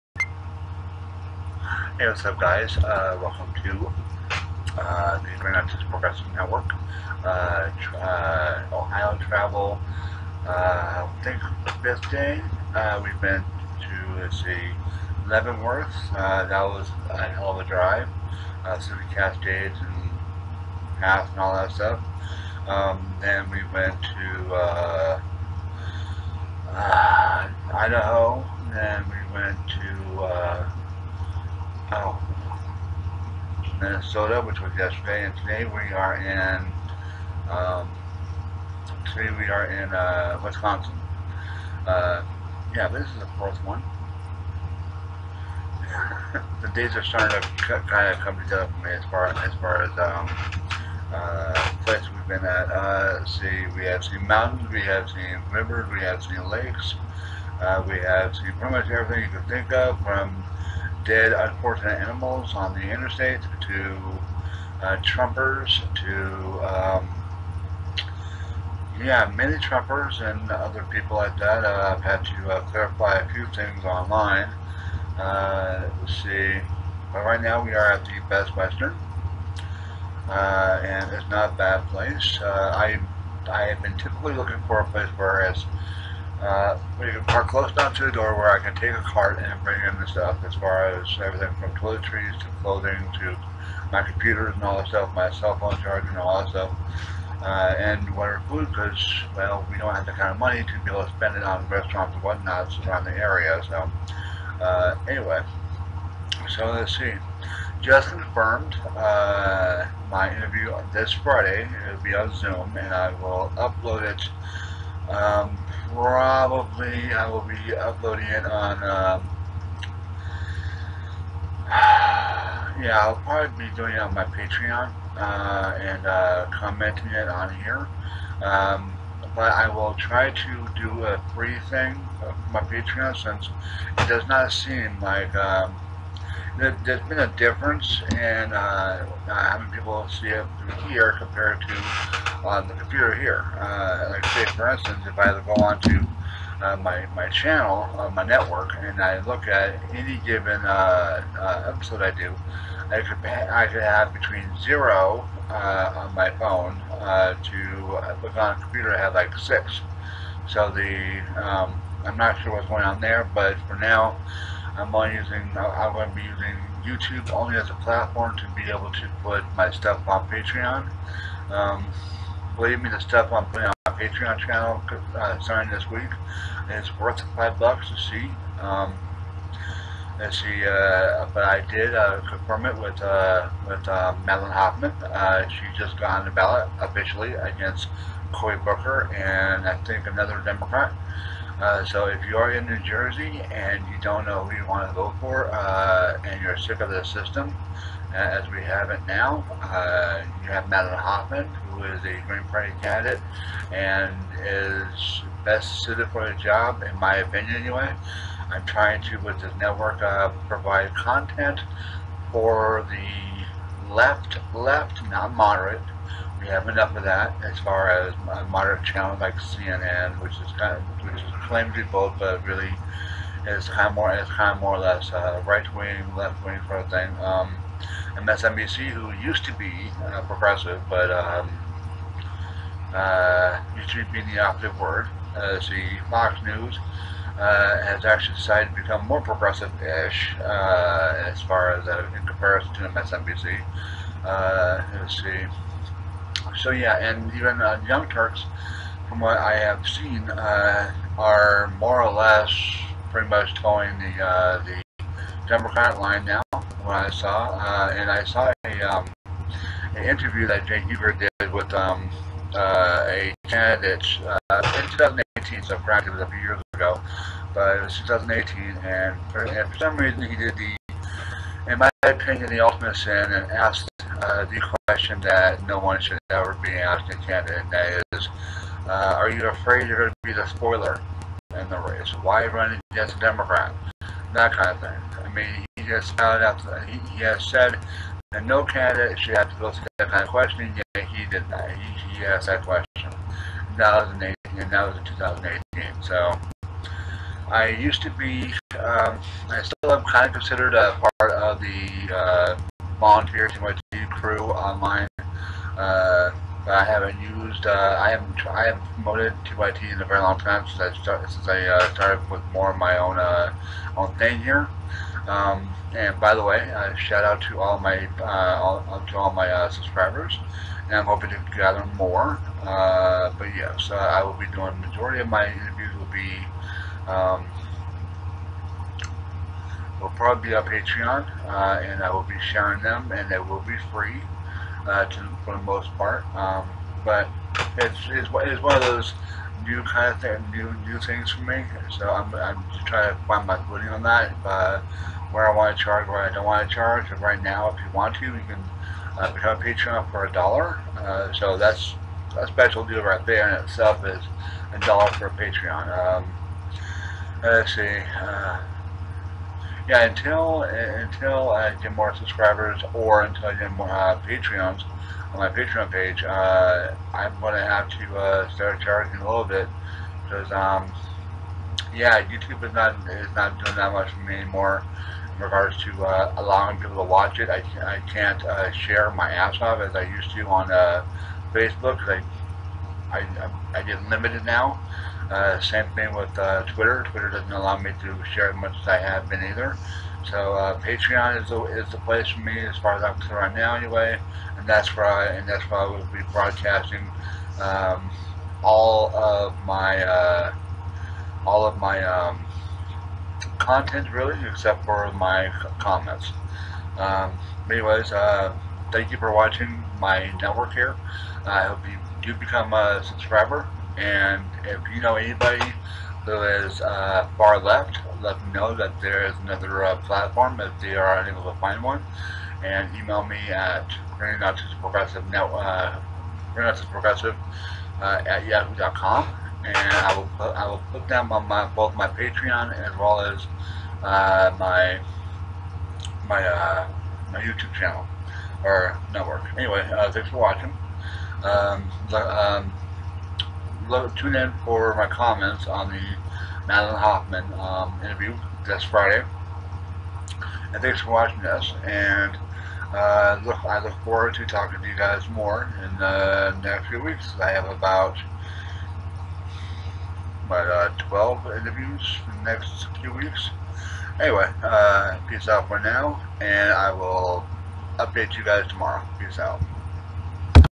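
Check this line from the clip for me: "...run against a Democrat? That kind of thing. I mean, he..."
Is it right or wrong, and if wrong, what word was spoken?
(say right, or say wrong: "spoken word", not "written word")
right.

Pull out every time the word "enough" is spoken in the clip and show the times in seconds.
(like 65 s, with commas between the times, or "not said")
87 s, 216 s.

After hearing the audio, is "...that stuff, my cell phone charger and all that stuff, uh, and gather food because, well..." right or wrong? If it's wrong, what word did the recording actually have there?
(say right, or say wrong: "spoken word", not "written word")
wrong: "whatever", not "gather".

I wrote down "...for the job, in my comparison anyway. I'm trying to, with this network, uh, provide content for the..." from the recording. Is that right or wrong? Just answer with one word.
wrong.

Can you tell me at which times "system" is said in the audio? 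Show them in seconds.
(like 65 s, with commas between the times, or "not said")
197 s.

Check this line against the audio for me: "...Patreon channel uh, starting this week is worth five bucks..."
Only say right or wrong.
right.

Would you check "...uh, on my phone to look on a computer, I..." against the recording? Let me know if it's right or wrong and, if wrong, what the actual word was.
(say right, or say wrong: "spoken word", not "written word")
right.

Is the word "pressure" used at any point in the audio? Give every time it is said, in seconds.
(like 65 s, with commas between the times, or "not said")
not said.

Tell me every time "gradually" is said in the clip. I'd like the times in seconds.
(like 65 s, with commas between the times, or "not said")
not said.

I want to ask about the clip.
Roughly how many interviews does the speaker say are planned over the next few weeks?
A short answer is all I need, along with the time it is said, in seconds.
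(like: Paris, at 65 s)
12, at 461 s.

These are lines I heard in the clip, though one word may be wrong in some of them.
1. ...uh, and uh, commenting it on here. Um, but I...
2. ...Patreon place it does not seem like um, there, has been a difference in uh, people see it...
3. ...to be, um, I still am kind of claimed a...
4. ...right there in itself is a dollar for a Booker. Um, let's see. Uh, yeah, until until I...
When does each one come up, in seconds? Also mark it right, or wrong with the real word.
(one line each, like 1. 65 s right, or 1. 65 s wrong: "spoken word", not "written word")
1. 125 s right
2. 132 s wrong: "since", not "place"
3. 298 s wrong: "considered", not "claimed"
4. 353 s wrong: "Patreon", not "Booker".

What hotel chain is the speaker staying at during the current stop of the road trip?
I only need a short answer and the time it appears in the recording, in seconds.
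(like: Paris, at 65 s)
Best Western, at 78 s.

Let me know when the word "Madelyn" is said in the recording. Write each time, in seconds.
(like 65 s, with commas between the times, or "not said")
184 s, 200 s, 446 s.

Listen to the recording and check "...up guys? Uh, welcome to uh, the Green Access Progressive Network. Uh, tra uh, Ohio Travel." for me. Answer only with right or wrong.
right.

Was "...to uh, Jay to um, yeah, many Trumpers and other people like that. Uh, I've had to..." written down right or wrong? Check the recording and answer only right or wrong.
wrong.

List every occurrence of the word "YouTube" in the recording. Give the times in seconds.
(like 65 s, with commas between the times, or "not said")
166 s, 372 s, 437 s.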